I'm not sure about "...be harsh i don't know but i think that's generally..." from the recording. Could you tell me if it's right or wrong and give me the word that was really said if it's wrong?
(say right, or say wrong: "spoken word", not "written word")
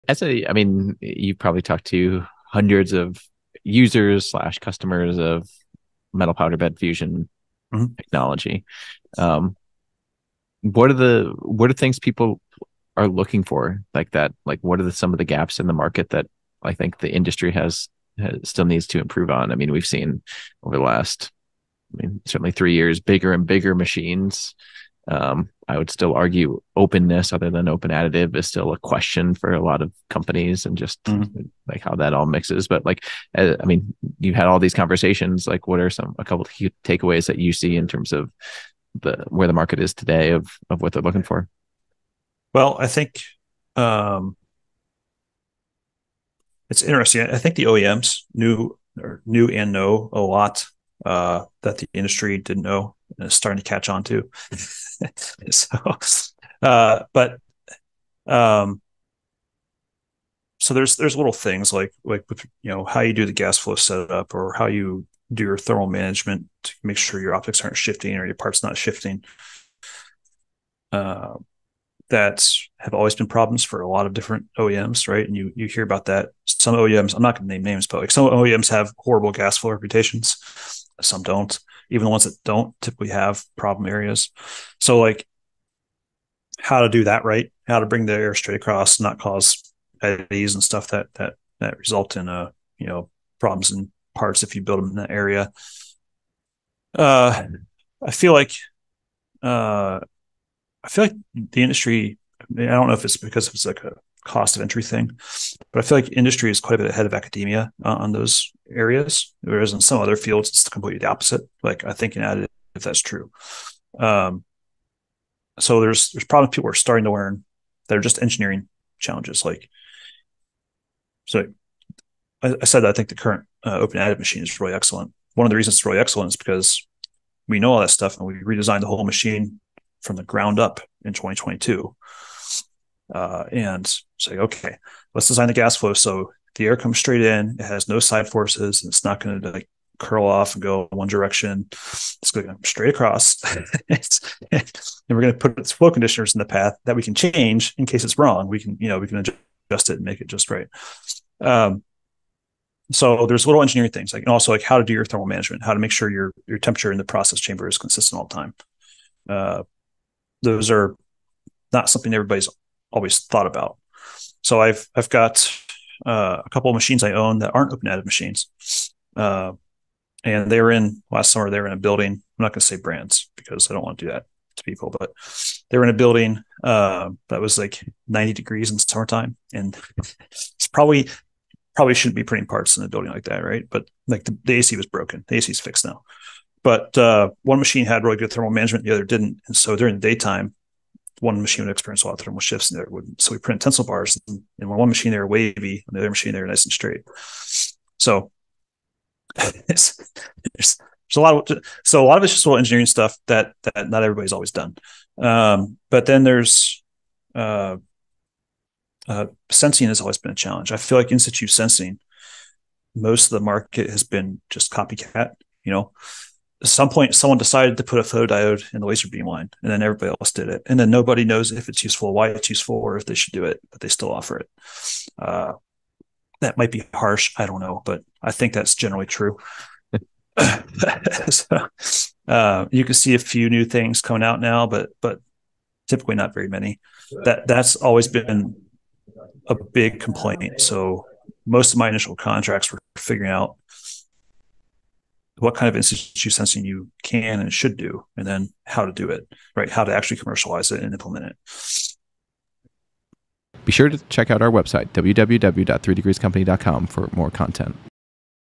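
right.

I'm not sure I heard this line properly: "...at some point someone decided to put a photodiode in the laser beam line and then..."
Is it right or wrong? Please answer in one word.
right.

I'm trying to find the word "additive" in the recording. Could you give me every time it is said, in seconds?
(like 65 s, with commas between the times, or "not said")
27 s, 112 s, 123 s, 167 s.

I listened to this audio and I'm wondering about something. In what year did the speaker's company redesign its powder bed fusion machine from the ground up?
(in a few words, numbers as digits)
2022.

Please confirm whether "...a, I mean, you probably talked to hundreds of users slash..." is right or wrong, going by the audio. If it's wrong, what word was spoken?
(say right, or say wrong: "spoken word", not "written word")
right.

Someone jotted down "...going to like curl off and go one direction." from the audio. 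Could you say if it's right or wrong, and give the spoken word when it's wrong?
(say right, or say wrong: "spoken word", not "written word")
right.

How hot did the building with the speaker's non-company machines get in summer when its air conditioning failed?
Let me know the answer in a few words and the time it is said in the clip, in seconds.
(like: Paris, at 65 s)
90 degrees, at 178 s.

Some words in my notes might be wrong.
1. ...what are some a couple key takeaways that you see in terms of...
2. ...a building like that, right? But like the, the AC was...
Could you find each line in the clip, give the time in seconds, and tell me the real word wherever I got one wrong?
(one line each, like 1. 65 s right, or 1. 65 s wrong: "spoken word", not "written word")
1. 35 s right
2. 182 s right.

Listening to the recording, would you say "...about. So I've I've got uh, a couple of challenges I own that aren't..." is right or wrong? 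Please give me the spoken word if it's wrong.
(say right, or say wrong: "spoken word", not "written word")
wrong: "machines", not "challenges".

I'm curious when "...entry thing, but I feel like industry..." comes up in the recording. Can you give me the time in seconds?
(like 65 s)
104 s.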